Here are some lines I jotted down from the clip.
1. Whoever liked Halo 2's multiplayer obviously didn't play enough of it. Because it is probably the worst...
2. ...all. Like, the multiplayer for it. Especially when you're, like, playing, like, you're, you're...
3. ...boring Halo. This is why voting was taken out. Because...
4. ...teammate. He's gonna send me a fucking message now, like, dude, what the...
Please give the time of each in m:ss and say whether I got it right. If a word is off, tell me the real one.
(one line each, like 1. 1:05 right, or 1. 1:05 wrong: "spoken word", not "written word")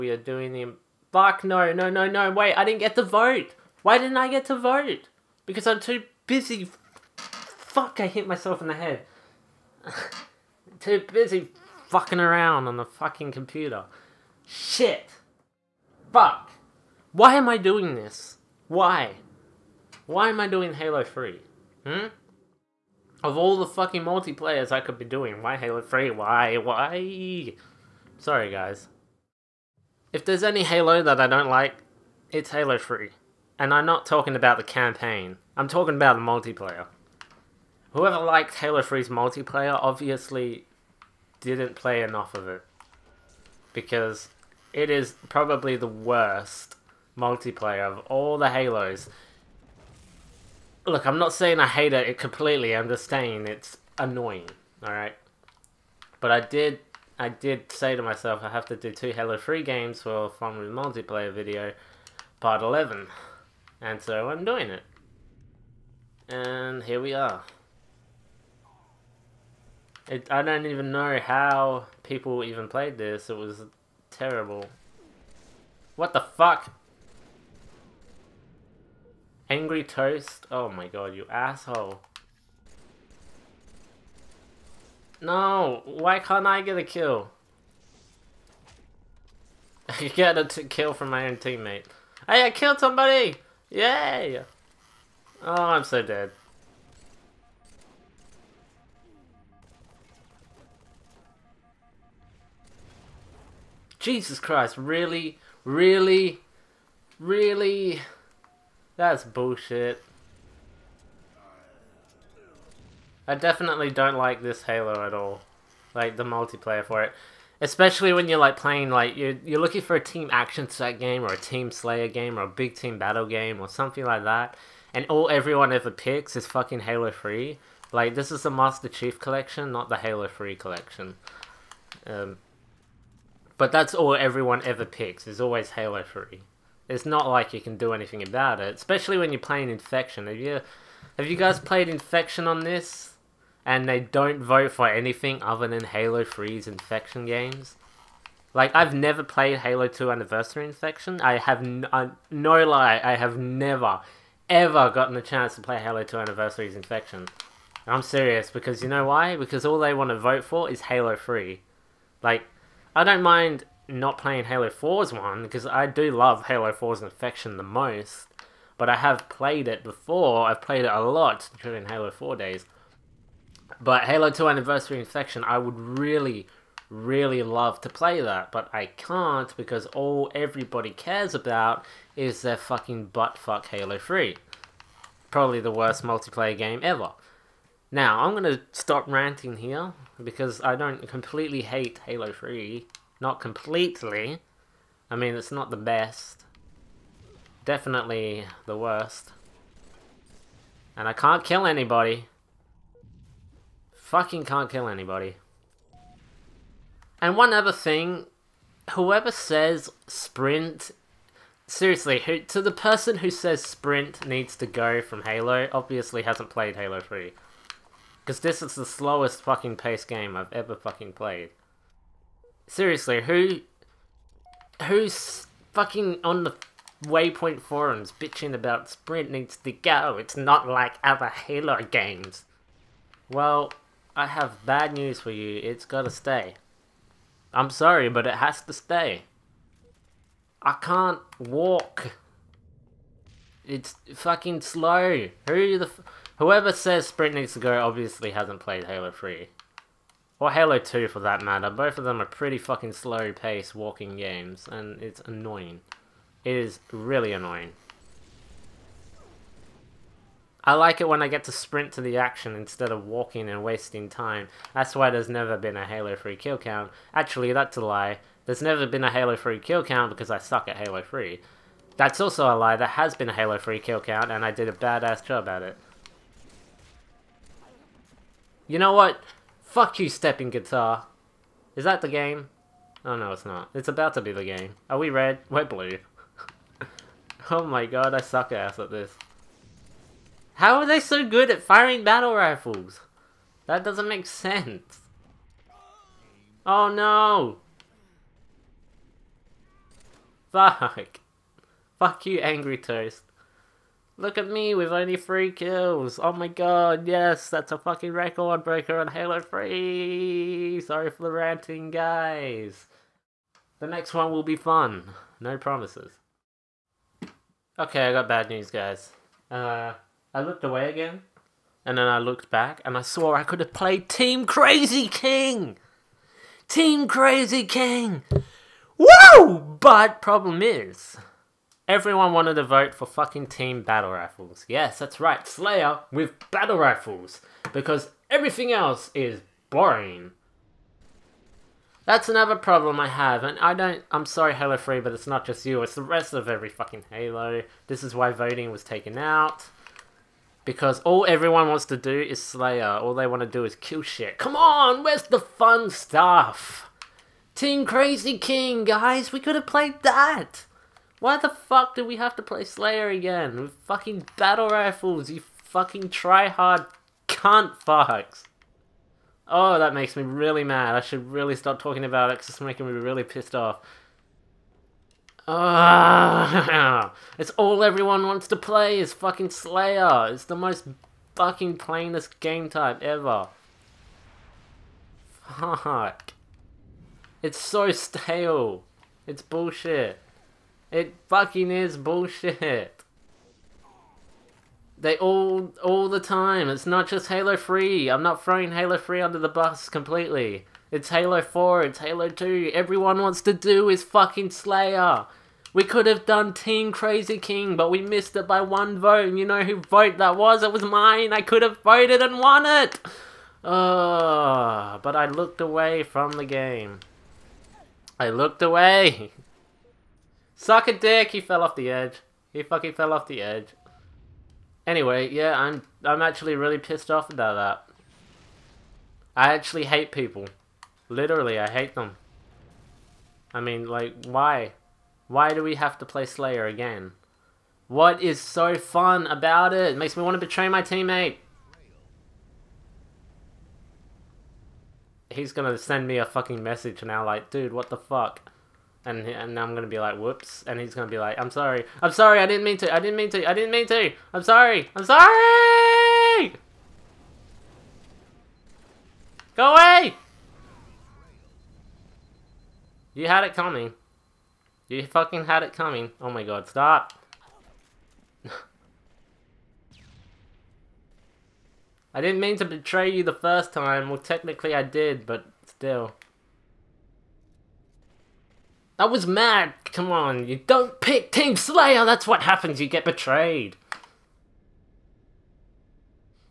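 1. 0:37 wrong: "3", not "2"
2. 1:55 right
3. 5:46 wrong: "fucking", not "boring"
4. 7:20 right.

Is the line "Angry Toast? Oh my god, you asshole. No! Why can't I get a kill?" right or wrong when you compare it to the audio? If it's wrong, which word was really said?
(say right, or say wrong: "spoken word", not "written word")
right.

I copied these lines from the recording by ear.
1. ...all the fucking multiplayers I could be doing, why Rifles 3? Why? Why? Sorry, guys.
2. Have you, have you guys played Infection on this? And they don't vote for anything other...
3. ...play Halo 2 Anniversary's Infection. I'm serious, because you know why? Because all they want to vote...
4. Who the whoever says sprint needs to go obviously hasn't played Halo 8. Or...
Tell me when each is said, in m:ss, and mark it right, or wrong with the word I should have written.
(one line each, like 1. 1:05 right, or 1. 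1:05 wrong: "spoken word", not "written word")
1. 0:23 wrong: "Halo", not "Rifles"
2. 2:20 right
3. 2:35 right
4. 4:05 wrong: "3", not "8".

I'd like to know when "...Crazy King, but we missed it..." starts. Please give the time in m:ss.
6:46.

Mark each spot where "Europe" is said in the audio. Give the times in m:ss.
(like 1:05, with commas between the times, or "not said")
not said.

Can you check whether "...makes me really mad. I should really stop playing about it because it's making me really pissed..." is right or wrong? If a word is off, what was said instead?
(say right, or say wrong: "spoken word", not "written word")
wrong: "talking", not "playing".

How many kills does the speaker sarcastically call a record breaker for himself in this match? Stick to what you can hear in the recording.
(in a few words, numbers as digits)
3.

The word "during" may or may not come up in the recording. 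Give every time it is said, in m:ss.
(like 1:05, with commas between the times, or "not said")
2:51.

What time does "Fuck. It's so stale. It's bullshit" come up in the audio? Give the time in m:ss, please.
6:25.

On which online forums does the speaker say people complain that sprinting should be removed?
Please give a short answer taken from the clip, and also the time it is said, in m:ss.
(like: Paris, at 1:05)
Waypoint, at 3:47.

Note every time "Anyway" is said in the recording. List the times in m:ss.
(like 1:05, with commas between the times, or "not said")
7:04.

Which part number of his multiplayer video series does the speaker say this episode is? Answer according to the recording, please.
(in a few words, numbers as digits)
11.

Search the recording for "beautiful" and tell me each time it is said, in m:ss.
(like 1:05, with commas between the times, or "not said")
not said.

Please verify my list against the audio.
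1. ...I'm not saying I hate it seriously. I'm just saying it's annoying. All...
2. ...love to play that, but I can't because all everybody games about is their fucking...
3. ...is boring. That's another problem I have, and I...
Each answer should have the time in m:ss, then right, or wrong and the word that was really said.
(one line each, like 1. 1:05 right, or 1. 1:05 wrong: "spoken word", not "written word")
1. 0:51 wrong: "completely", not "seriously"
2. 2:57 wrong: "cares", not "games"
3. 5:39 right.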